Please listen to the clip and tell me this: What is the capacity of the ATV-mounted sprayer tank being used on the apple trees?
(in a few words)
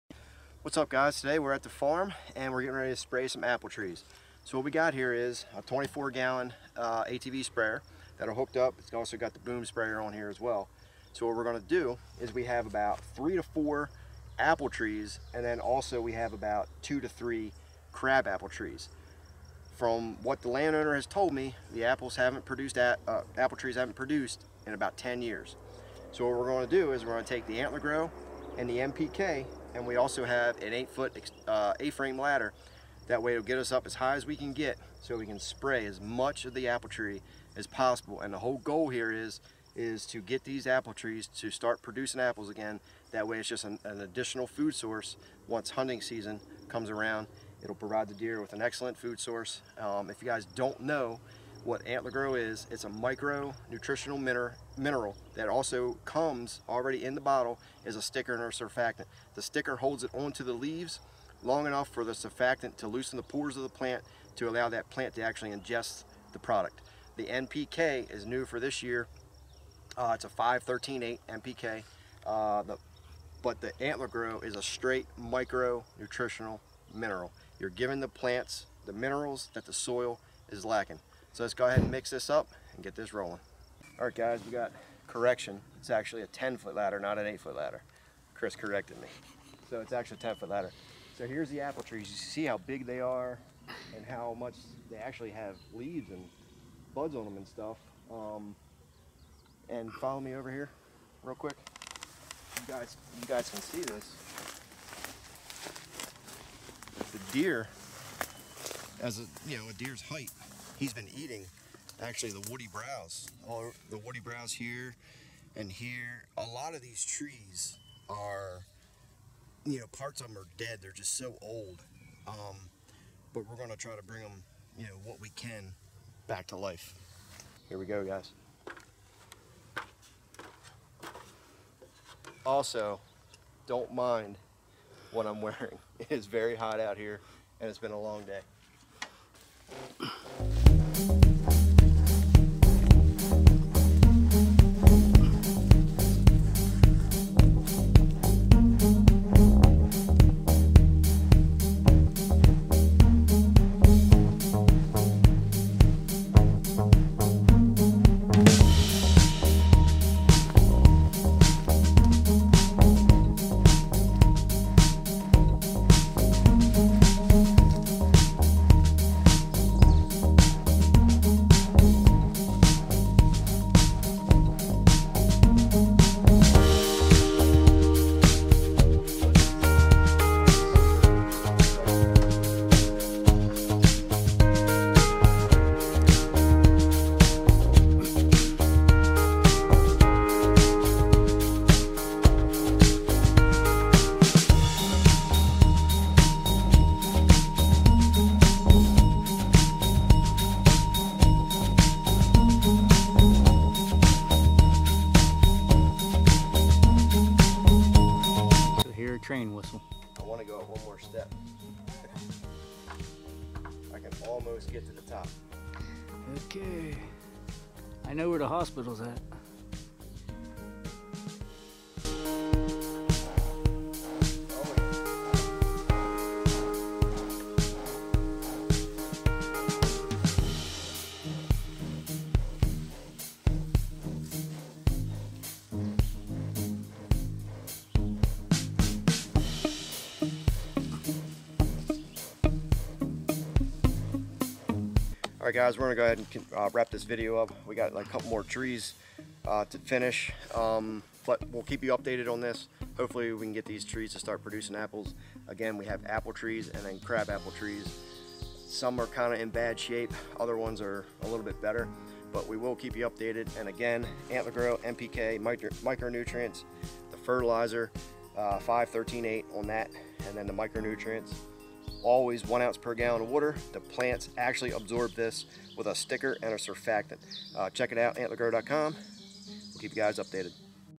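24 gallons.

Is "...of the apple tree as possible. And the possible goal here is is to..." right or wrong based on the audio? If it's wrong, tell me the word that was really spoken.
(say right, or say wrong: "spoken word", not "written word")
wrong: "whole", not "possible".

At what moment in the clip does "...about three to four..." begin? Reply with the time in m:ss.
0:12.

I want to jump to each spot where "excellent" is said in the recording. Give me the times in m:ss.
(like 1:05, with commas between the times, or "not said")
0:48.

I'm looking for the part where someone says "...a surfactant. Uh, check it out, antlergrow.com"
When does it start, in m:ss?
4:36.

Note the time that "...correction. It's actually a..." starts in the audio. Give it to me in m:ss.
1:25.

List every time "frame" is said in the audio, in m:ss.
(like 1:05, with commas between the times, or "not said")
0:31.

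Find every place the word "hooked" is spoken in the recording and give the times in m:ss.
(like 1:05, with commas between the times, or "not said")
0:08.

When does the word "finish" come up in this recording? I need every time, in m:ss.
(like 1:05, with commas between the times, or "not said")
4:09.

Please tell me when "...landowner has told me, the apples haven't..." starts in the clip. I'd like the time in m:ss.
0:20.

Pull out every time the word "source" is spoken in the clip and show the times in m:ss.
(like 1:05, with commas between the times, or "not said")
0:44, 0:49.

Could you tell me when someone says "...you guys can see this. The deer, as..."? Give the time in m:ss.
1:43.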